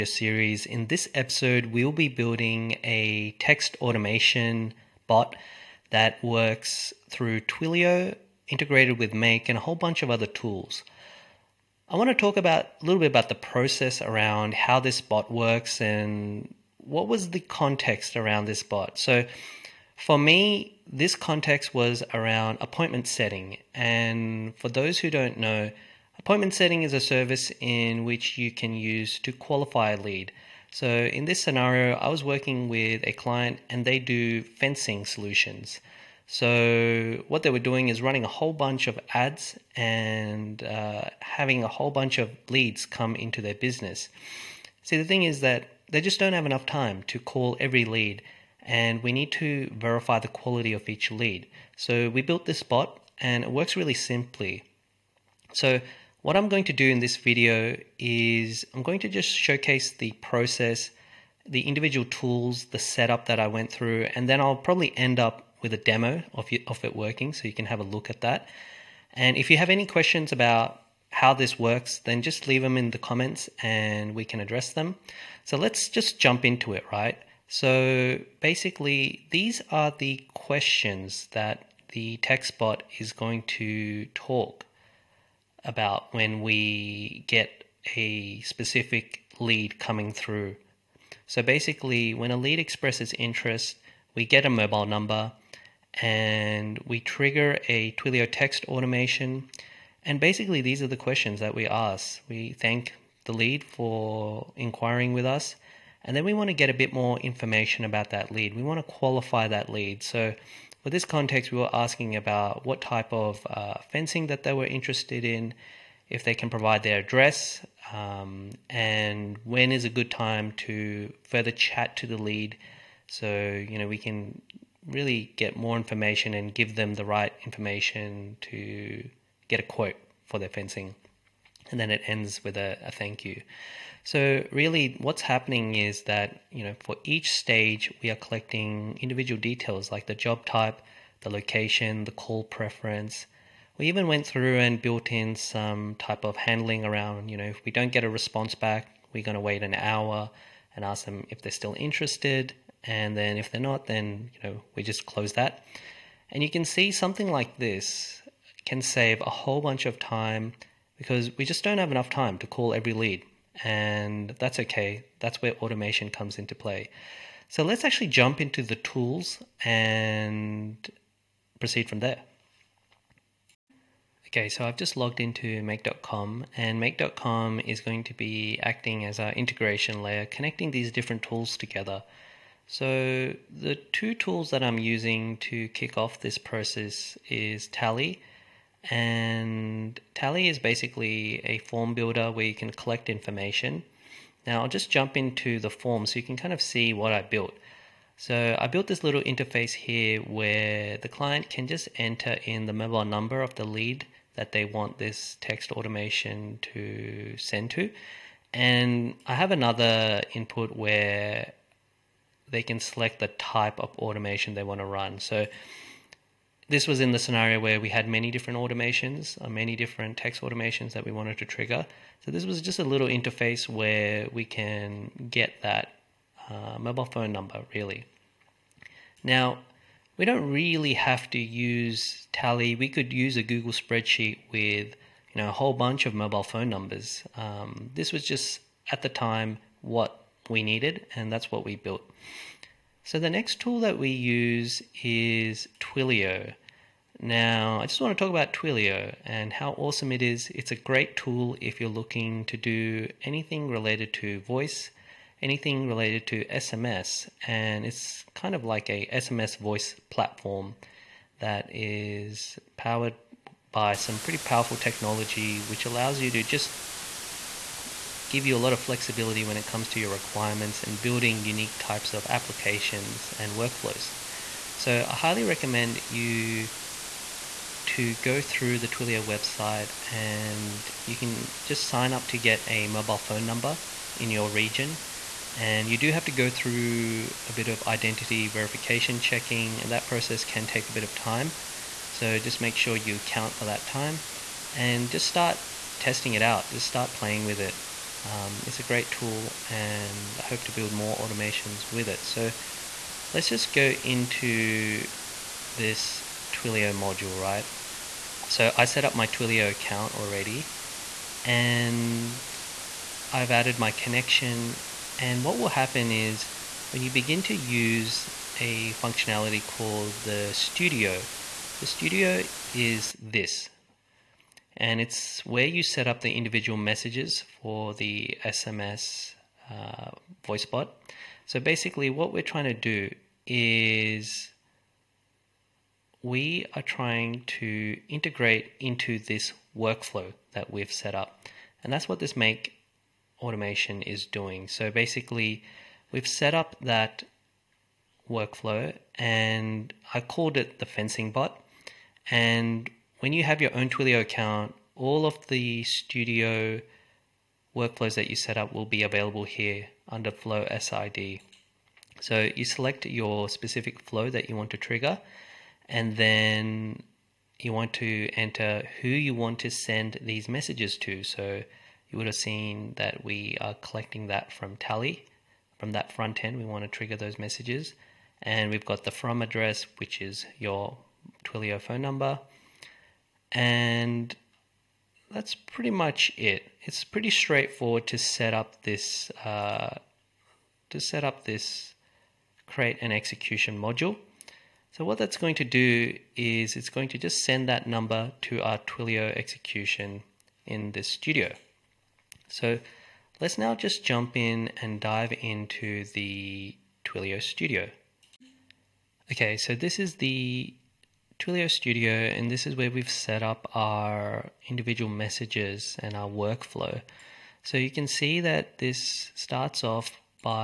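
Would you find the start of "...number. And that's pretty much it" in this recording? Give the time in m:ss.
6:22.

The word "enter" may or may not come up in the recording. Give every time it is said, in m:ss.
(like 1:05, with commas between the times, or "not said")
3:21, 6:08.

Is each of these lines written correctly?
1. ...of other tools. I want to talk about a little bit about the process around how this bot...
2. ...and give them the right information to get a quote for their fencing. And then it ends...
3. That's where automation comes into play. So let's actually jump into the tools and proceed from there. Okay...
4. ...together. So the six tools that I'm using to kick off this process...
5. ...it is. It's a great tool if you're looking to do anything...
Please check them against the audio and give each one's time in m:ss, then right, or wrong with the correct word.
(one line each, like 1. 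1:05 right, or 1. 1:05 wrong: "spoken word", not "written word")
1. 0:10 right
2. 2:06 right
3. 2:45 right
4. 3:01 wrong: "two", not "six"
5. 4:10 right.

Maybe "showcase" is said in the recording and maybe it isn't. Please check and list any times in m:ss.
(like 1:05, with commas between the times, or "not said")
0:59.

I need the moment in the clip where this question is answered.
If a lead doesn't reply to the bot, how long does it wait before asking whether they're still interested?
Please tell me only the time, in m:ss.
2:29.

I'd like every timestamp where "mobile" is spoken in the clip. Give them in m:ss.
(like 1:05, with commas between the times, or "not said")
1:34, 3:22, 3:46, 3:56, 4:42.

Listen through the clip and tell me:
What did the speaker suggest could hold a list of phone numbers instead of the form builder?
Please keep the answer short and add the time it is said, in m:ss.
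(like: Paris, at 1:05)
Google spreadsheet, at 3:53.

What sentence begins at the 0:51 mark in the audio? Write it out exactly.
So, we built this bot and it works really simply.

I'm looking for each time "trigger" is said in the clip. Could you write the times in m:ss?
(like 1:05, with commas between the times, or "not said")
1:37, 3:41, 6:04, 6:16.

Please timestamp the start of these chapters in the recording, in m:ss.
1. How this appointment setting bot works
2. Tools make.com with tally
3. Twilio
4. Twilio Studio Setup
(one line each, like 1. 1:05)
1. 1:18
2. 2:53
3. 4:05
4. 6:45.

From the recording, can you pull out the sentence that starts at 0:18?
So, for me, this context was around appointment setting.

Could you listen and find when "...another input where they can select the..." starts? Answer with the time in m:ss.
3:29.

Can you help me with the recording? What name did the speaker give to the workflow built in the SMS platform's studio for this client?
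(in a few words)
Fencing bot.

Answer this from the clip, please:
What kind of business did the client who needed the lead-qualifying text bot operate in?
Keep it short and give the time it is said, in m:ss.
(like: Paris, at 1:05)
Fencing solutions, at 0:34.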